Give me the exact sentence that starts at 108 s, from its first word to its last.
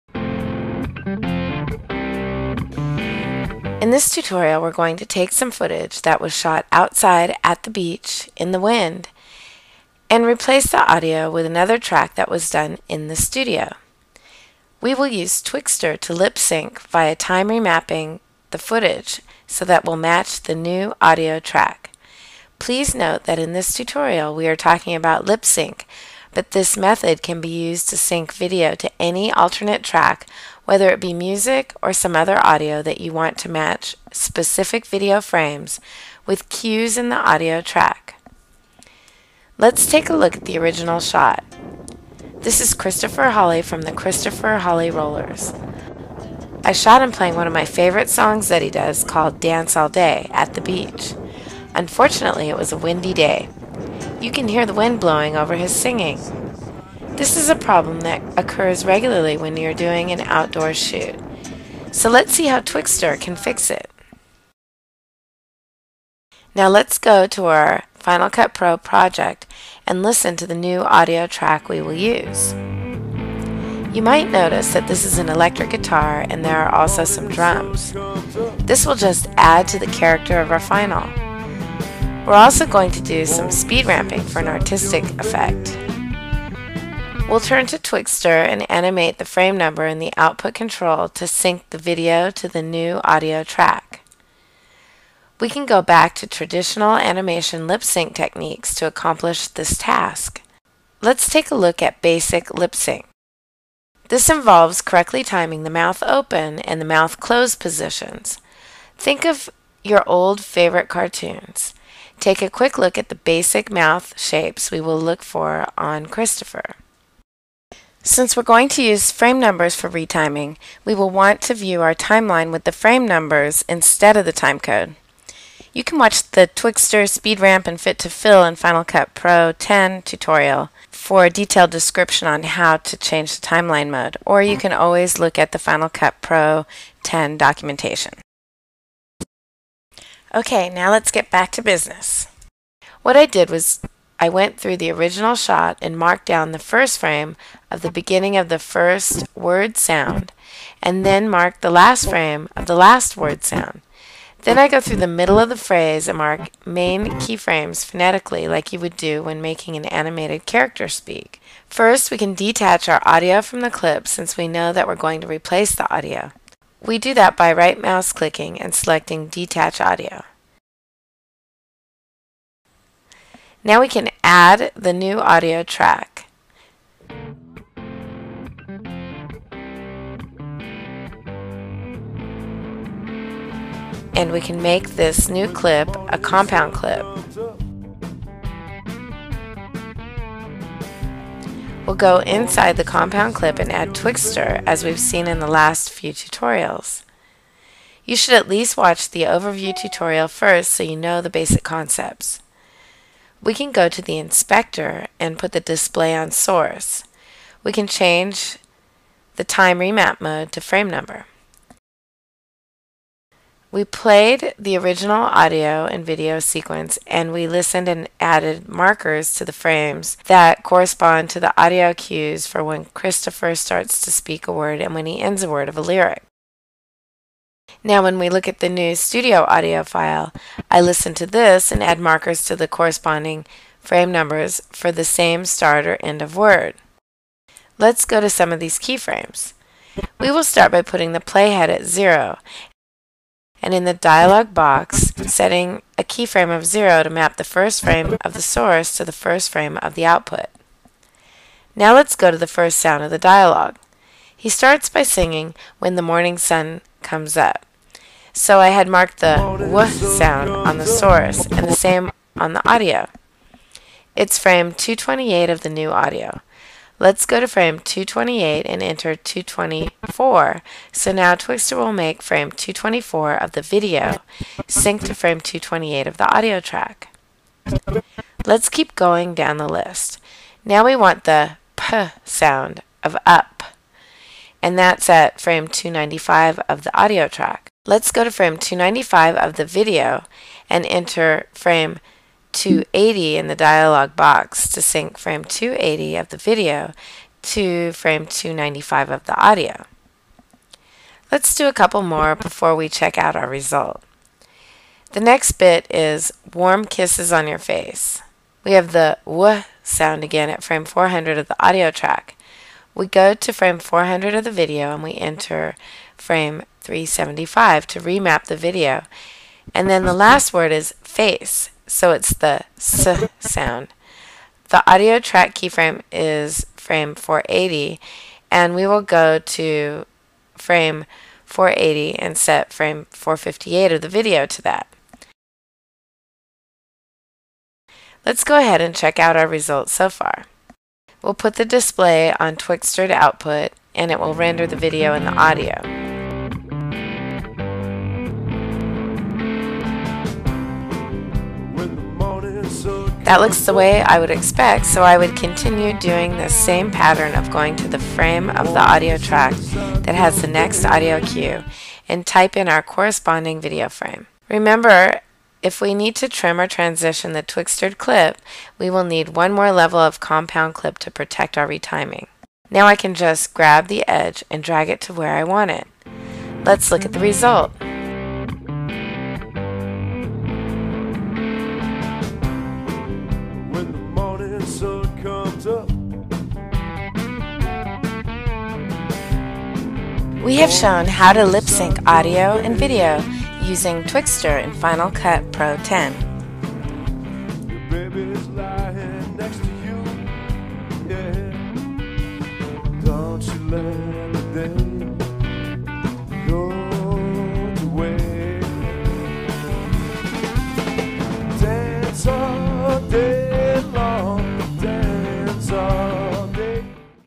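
Think of your old favorite cartoons.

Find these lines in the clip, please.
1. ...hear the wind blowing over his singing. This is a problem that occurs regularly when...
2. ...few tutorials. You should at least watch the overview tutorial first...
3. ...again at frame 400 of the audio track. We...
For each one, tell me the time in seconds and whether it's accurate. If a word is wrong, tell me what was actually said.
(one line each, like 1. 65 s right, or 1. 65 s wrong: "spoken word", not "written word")
1. 54 s right
2. 195 s right
3. 310 s right.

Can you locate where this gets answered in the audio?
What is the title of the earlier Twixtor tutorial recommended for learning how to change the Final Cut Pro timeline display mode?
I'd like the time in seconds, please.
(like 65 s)
127 s.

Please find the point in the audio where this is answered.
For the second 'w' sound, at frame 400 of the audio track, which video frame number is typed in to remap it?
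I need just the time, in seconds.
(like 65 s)
316 s.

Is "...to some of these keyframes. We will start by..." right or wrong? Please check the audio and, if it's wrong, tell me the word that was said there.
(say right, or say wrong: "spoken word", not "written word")
right.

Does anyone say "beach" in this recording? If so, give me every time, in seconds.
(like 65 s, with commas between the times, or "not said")
7 s, 50 s.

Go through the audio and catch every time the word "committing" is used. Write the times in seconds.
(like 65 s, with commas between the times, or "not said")
not said.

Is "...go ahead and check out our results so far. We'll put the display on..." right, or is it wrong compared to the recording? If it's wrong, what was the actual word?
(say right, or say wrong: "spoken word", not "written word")
right.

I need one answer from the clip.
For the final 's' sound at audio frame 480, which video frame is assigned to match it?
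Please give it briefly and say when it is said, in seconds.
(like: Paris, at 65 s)
458, at 333 s.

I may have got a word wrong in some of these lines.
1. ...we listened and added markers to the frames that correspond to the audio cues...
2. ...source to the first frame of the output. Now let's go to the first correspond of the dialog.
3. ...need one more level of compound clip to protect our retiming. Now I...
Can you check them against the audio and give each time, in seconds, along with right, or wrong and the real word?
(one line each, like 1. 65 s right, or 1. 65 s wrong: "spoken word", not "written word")
1. 217 s right
2. 248 s wrong: "sound", not "correspond"
3. 369 s right.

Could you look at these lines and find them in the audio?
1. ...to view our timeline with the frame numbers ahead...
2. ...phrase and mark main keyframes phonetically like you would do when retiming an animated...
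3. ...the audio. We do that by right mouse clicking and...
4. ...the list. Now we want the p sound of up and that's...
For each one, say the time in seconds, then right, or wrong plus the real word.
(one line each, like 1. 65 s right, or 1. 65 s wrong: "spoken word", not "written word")
1. 121 s wrong: "instead", not "ahead"
2. 155 s wrong: "making", not "retiming"
3. 165 s right
4. 279 s right.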